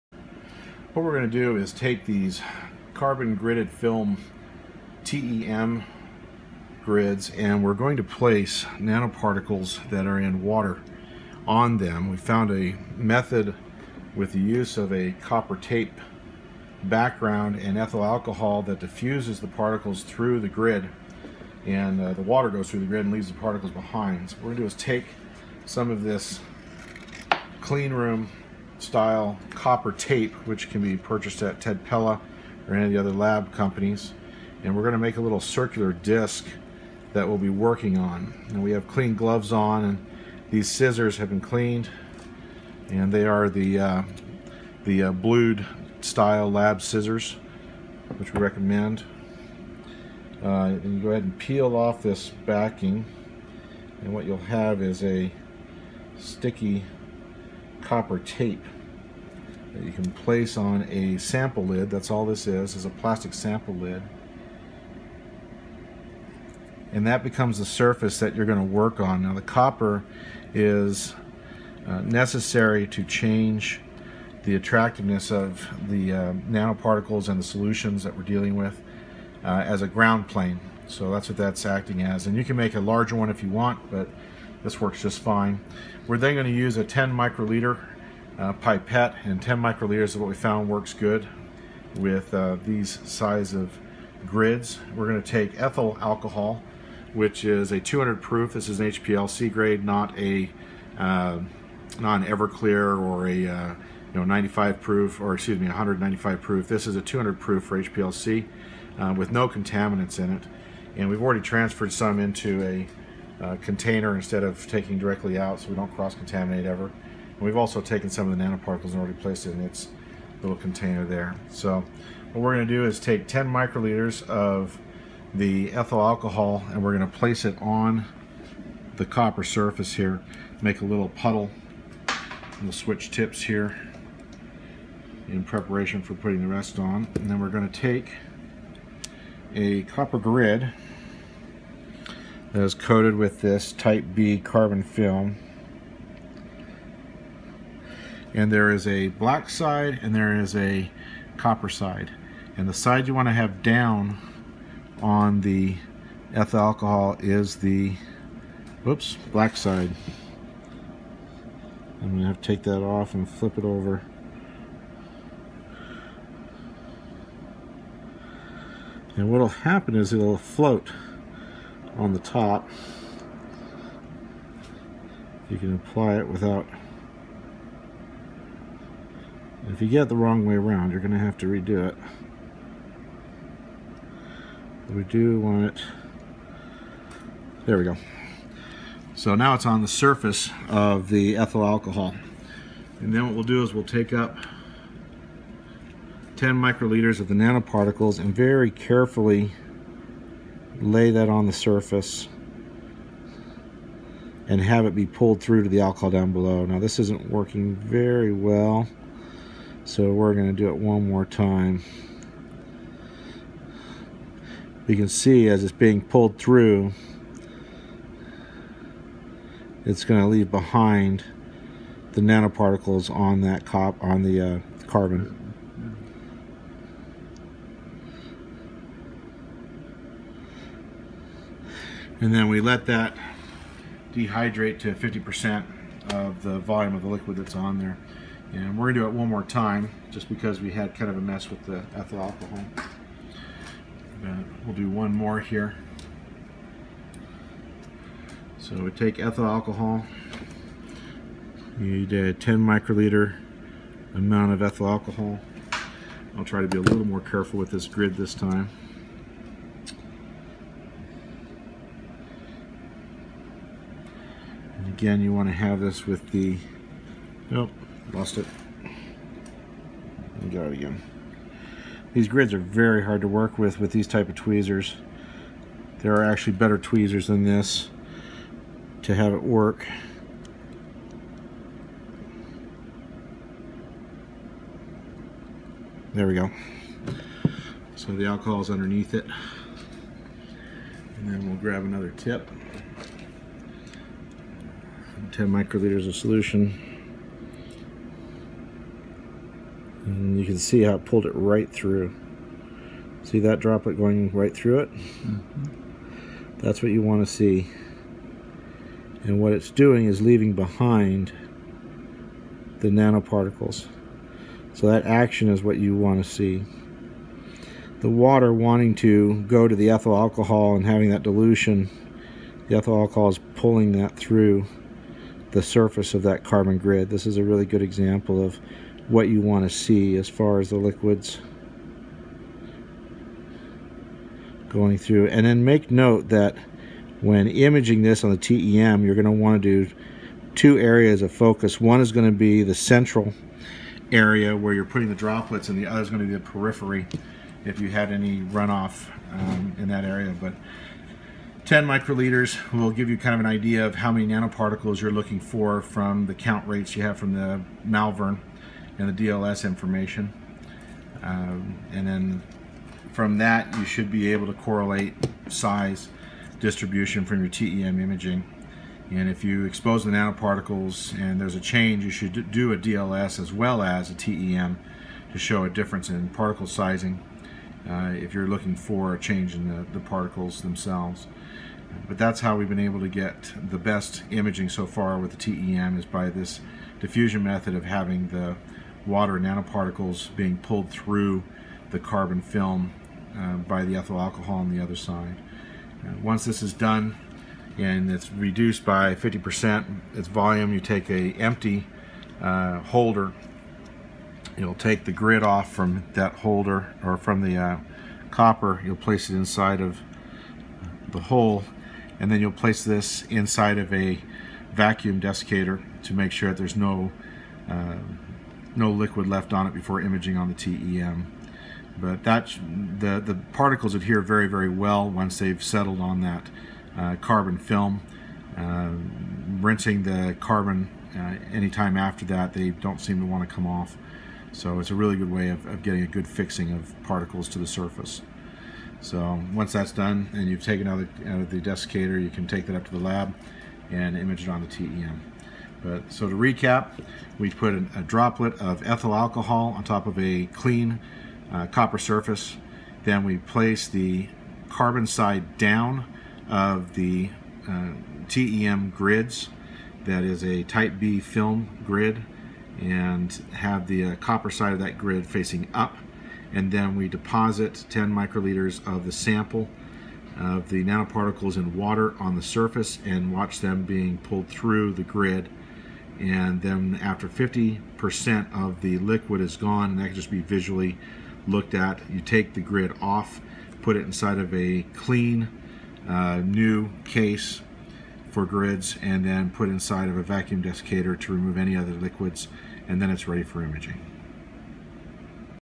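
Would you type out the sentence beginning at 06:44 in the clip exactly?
You'll take the grid off from that holder or from the uh, copper.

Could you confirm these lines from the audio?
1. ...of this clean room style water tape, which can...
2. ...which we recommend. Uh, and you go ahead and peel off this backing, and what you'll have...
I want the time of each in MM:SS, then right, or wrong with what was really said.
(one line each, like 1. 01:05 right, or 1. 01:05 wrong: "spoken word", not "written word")
1. 00:25 wrong: "copper", not "water"
2. 00:48 right.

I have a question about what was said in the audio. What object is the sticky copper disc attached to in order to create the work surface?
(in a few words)
plastic sample lid.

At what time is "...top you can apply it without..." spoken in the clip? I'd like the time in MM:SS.
02:52.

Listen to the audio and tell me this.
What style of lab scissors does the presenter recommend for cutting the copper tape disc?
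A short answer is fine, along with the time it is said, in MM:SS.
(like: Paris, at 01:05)
blued, at 00:45.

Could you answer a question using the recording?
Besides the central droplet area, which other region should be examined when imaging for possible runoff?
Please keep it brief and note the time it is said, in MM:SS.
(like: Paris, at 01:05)
periphery, at 05:46.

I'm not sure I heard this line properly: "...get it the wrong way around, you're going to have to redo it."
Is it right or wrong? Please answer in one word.
right.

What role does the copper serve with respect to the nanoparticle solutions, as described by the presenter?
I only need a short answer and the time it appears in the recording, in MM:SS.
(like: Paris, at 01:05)
ground plane, at 01:19.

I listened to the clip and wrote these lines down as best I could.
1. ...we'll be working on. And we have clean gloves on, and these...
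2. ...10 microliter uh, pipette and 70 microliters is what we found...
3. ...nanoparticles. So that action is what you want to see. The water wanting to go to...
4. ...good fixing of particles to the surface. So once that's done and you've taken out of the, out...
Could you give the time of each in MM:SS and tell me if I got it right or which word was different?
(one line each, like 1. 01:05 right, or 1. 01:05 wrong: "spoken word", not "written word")
1. 00:37 right
2. 01:26 wrong: "10", not "70"
3. 05:12 right
4. 07:16 right.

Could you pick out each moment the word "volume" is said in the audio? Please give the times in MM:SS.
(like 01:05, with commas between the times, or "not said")
03:56, 06:40.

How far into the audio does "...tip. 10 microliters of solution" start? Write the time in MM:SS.
04:52.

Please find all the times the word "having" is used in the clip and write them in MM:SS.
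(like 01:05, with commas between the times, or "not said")
05:20, 06:27.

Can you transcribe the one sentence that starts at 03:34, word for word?
We can see as it's being pulled through, it's going to leave behind the nanoparticles on that cop on the uh, carbon.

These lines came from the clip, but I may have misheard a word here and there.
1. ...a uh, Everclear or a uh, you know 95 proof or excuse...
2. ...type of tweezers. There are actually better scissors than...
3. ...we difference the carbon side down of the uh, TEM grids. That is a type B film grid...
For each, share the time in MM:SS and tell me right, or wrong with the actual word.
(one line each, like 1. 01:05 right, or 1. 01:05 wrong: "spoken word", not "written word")
1. 01:40 right
2. 04:34 wrong: "tweezers", not "scissors"
3. 07:33 wrong: "place", not "difference".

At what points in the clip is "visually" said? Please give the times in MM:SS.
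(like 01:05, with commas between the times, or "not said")
08:00.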